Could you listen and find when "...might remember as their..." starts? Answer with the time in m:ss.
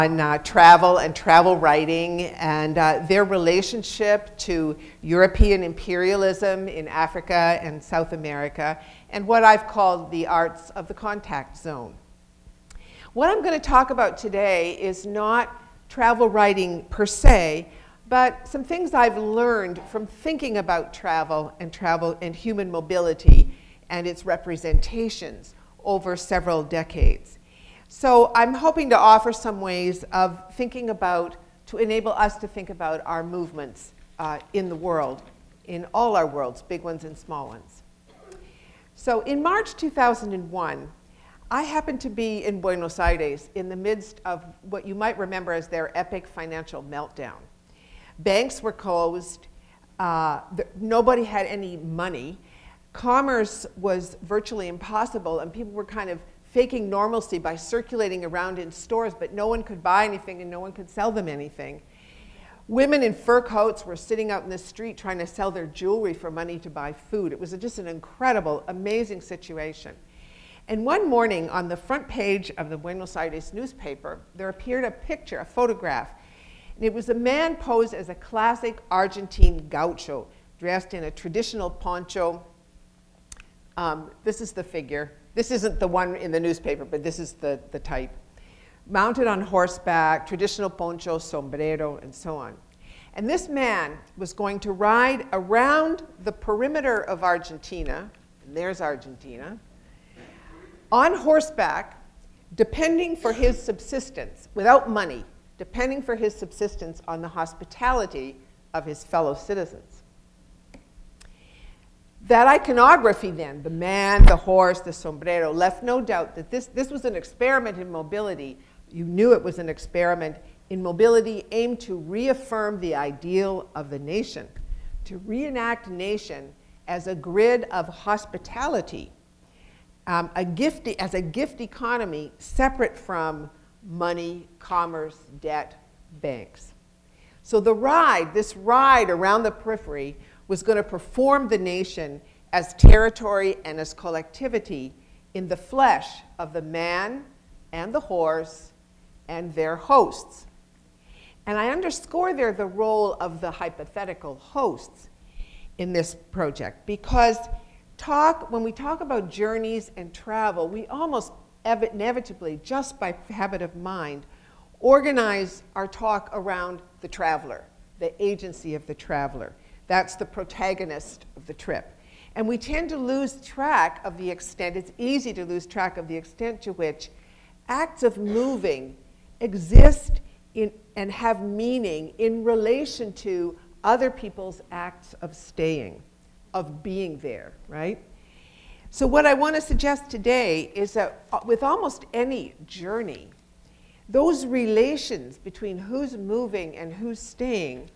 0:44.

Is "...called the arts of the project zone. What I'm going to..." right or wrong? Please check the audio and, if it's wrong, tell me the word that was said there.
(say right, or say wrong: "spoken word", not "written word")
wrong: "contact", not "project".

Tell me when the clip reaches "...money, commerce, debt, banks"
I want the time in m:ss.
2:13.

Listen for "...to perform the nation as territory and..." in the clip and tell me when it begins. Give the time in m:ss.
2:20.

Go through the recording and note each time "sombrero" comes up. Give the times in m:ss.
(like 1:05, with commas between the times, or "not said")
1:31, 1:54.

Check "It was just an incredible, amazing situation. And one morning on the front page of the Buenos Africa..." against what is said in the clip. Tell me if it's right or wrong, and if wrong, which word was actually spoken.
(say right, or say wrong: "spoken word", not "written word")
wrong: "Aires", not "Africa".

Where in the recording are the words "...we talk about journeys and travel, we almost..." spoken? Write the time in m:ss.
2:38.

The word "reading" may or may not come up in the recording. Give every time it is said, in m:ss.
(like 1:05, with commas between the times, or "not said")
not said.